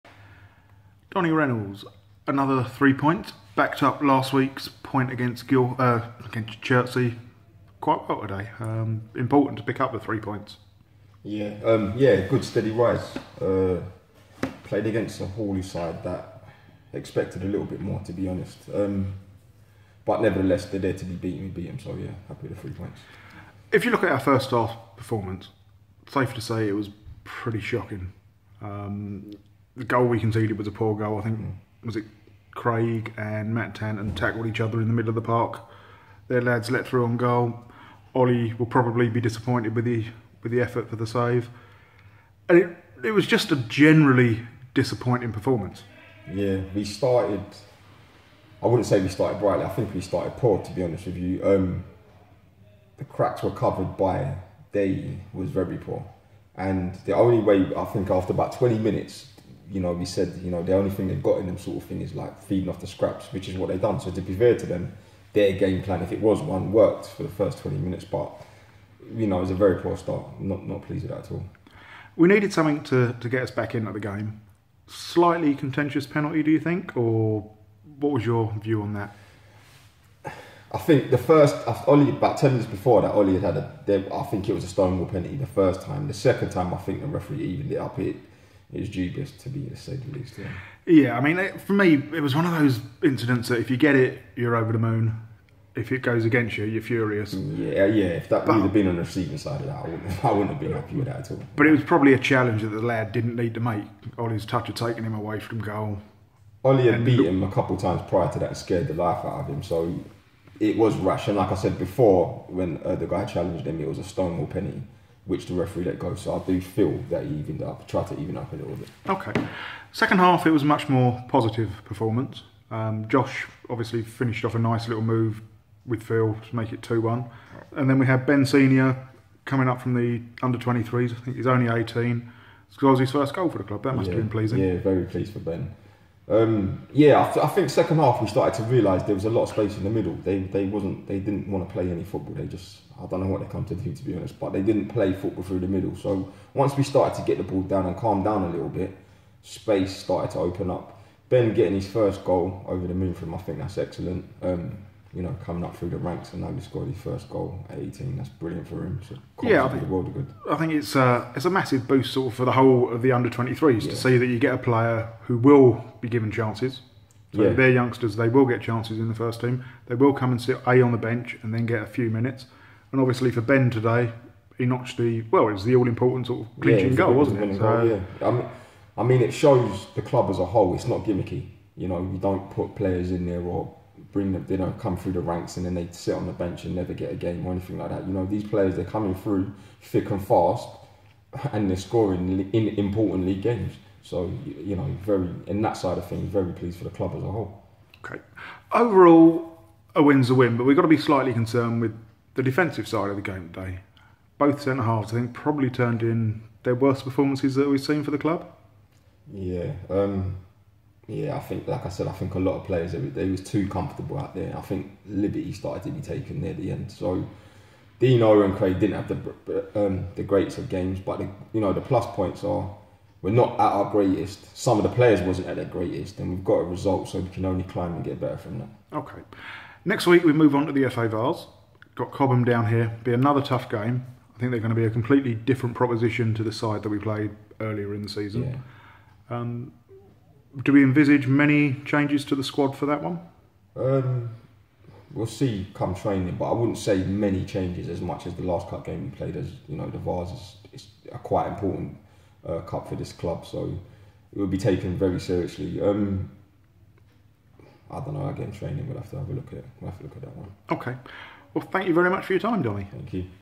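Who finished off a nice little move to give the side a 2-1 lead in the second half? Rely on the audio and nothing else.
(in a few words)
Josh.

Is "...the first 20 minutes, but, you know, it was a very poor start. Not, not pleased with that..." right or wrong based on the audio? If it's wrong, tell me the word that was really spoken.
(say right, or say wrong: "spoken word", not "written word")
right.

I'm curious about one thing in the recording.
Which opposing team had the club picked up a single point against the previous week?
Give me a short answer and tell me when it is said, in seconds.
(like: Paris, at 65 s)
Chertsey, at 6 s.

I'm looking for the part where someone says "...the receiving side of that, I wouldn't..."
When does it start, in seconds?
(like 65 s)
98 s.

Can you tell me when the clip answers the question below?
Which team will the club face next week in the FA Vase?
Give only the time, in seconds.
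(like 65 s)
232 s.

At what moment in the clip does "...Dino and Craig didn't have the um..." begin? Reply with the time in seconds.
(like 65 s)
217 s.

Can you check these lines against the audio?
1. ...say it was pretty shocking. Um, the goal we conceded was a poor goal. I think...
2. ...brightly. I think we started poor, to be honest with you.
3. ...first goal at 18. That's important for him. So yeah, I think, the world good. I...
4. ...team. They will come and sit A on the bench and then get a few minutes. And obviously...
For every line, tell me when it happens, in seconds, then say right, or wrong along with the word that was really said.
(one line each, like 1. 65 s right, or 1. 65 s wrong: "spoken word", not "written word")
1. 26 s right
2. 49 s right
3. 156 s wrong: "brilliant", not "important"
4. 169 s right.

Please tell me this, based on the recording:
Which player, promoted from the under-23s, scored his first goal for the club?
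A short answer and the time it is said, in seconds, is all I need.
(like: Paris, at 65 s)
Ben Senior, at 128 s.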